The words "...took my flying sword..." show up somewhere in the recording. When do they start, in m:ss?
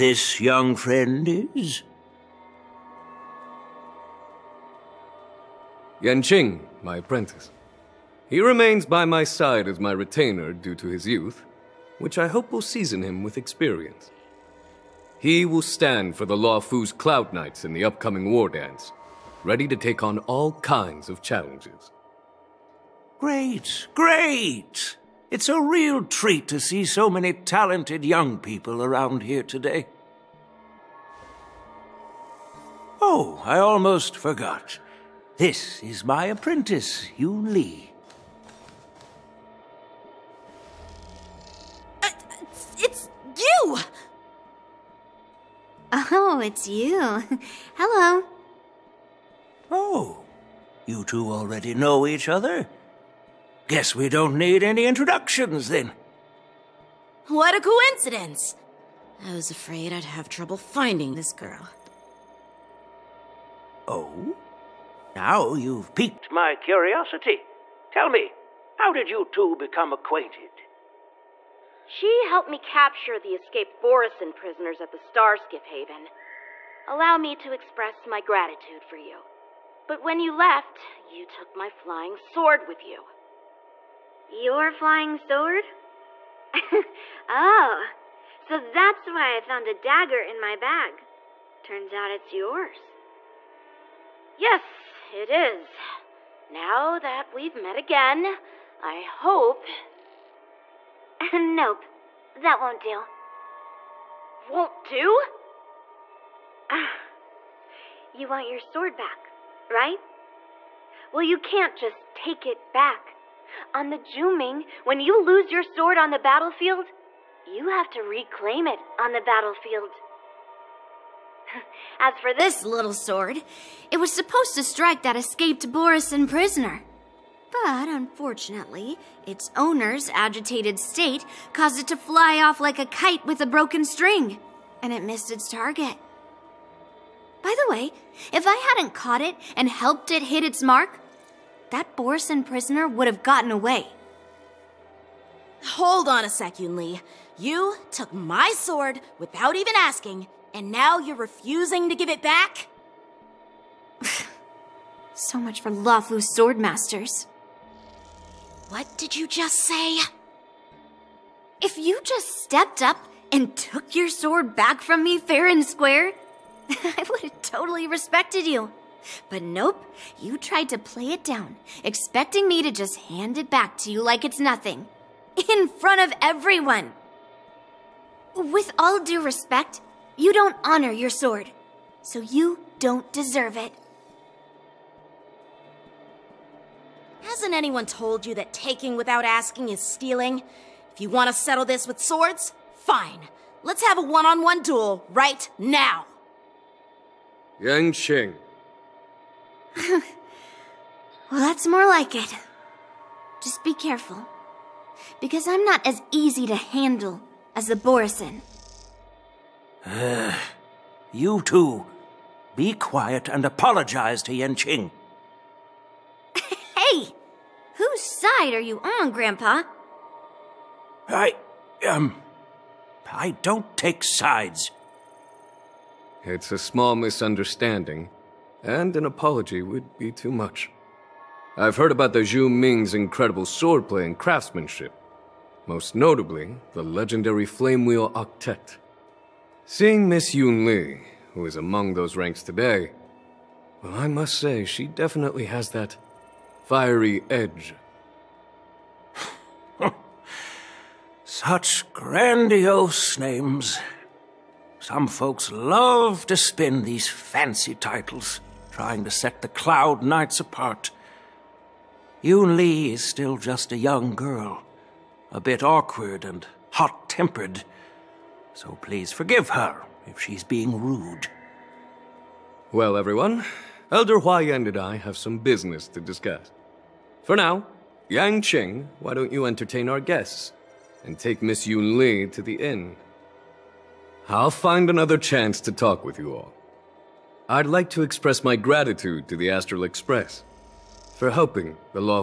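1:21.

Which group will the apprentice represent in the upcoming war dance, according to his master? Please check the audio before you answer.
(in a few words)
Luofu's Cloud Knights.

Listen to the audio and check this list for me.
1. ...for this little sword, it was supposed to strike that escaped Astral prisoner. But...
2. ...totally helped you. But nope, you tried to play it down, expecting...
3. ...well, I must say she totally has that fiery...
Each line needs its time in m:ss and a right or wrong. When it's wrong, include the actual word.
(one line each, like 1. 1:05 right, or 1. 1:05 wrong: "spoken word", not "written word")
1. 2:02 wrong: "Borisin", not "Astral"
2. 2:47 wrong: "respected", not "helped"
3. 4:03 wrong: "definitely", not "totally".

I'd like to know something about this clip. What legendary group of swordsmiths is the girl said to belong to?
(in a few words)
Flame Wheel Octet.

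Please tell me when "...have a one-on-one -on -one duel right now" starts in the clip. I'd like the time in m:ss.
3:13.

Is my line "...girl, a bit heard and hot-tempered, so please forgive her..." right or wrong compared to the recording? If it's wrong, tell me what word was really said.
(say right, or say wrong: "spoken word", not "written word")
wrong: "awkward", not "heard".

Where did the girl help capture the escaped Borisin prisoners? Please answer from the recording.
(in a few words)
Starskiff Haven.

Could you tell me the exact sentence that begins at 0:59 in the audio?
I was afraid I'd have trouble finding this girl.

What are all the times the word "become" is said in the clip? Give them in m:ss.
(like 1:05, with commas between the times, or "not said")
1:09.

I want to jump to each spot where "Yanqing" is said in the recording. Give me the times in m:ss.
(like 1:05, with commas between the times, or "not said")
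0:06, 3:34, 4:38.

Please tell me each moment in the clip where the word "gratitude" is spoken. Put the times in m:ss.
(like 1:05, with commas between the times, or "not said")
1:18, 4:48.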